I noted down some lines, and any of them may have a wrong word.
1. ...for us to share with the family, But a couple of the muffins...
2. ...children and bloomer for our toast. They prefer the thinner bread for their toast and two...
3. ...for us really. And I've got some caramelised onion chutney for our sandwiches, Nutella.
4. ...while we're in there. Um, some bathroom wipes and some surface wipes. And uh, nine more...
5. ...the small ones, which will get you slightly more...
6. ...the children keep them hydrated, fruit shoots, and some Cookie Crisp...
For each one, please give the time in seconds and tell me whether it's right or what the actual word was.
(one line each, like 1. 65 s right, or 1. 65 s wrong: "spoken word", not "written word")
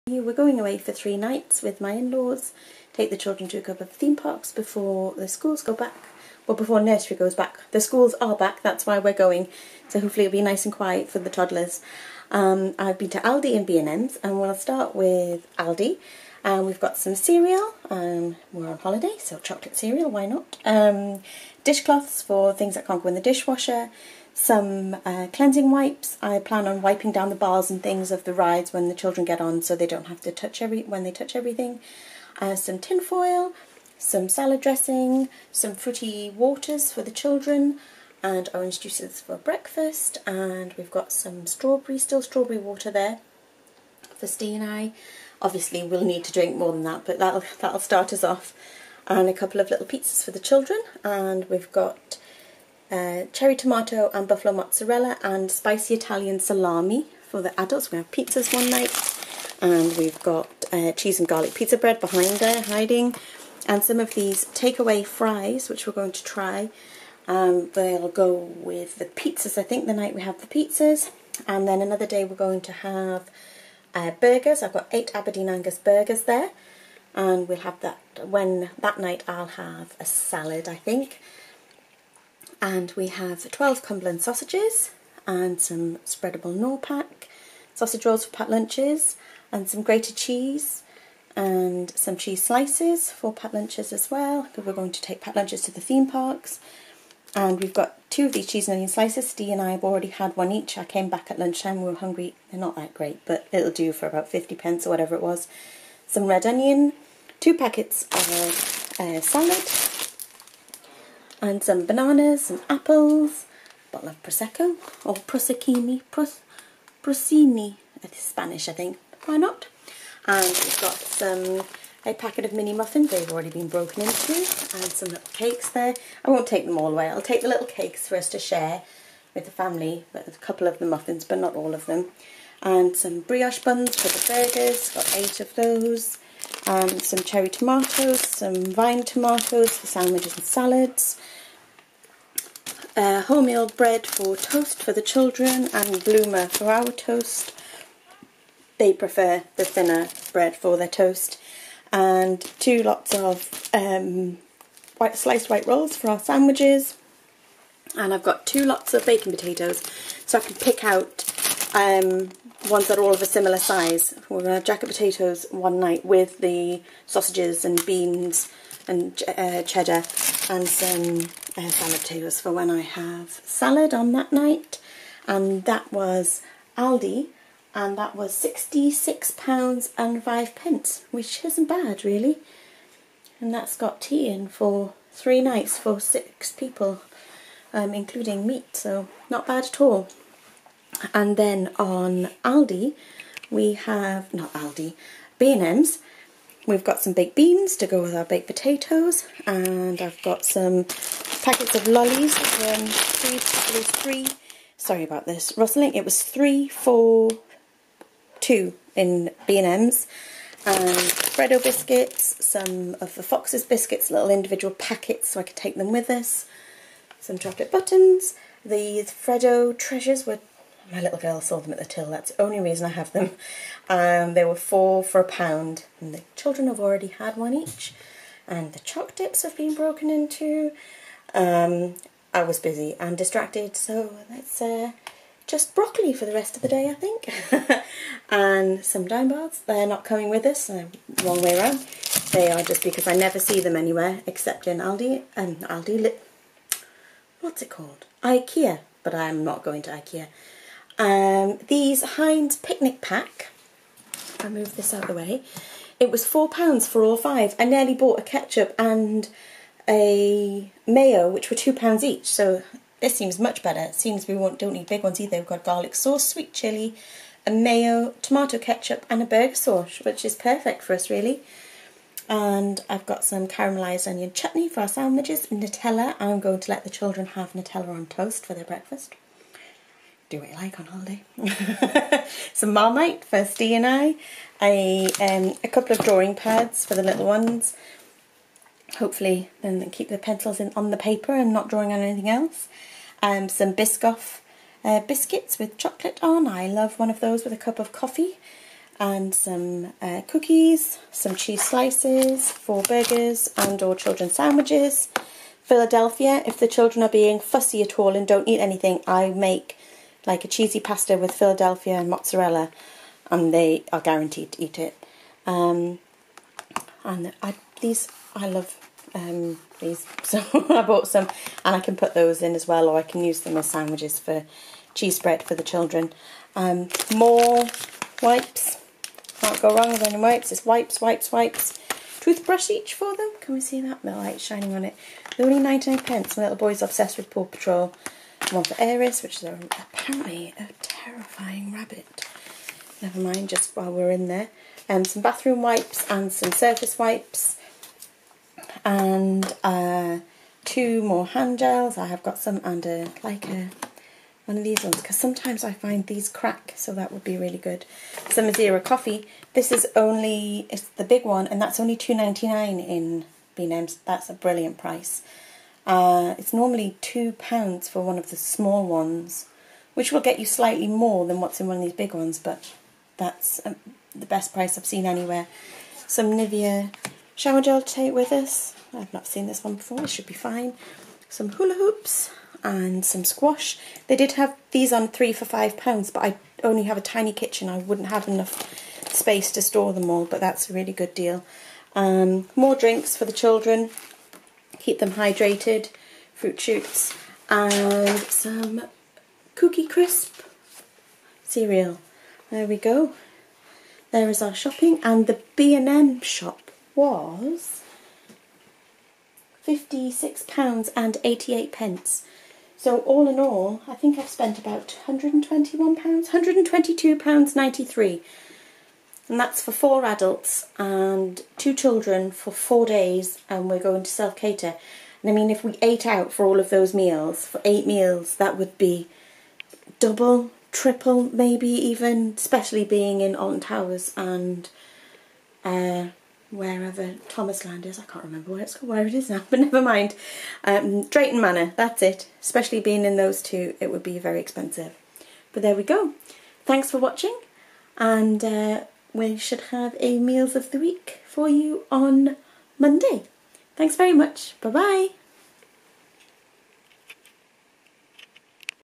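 1. 128 s right
2. 145 s right
3. 270 s right
4. 343 s wrong: "two", not "nine"
5. 368 s right
6. 393 s right.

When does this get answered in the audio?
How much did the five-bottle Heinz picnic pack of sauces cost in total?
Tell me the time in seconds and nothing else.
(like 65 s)
256 s.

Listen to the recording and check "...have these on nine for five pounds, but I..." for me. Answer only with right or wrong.
wrong.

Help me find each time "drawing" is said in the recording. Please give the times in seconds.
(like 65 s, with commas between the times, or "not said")
286 s, 291 s.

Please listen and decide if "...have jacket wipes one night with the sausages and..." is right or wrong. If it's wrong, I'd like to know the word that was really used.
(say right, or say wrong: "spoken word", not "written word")
wrong: "potatoes", not "wipes".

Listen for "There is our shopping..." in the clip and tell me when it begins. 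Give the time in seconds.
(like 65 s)
404 s.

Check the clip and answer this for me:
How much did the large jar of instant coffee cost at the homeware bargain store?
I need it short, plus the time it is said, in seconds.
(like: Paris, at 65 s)
£2.99, at 361 s.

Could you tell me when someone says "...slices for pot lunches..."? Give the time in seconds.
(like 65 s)
92 s.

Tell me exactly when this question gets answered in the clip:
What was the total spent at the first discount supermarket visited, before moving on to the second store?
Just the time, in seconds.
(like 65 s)
178 s.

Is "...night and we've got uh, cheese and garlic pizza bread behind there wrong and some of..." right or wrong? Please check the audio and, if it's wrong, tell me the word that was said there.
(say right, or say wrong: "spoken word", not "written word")
wrong: "hiding", not "wrong".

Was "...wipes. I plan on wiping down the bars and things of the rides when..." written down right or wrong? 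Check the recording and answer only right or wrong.
right.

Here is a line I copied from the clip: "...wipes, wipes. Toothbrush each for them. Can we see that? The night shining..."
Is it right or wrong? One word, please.
wrong.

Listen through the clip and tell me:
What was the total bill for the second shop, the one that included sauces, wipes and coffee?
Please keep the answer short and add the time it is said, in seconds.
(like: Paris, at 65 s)
£56.88, at 409 s.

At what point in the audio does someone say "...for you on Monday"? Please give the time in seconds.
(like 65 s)
451 s.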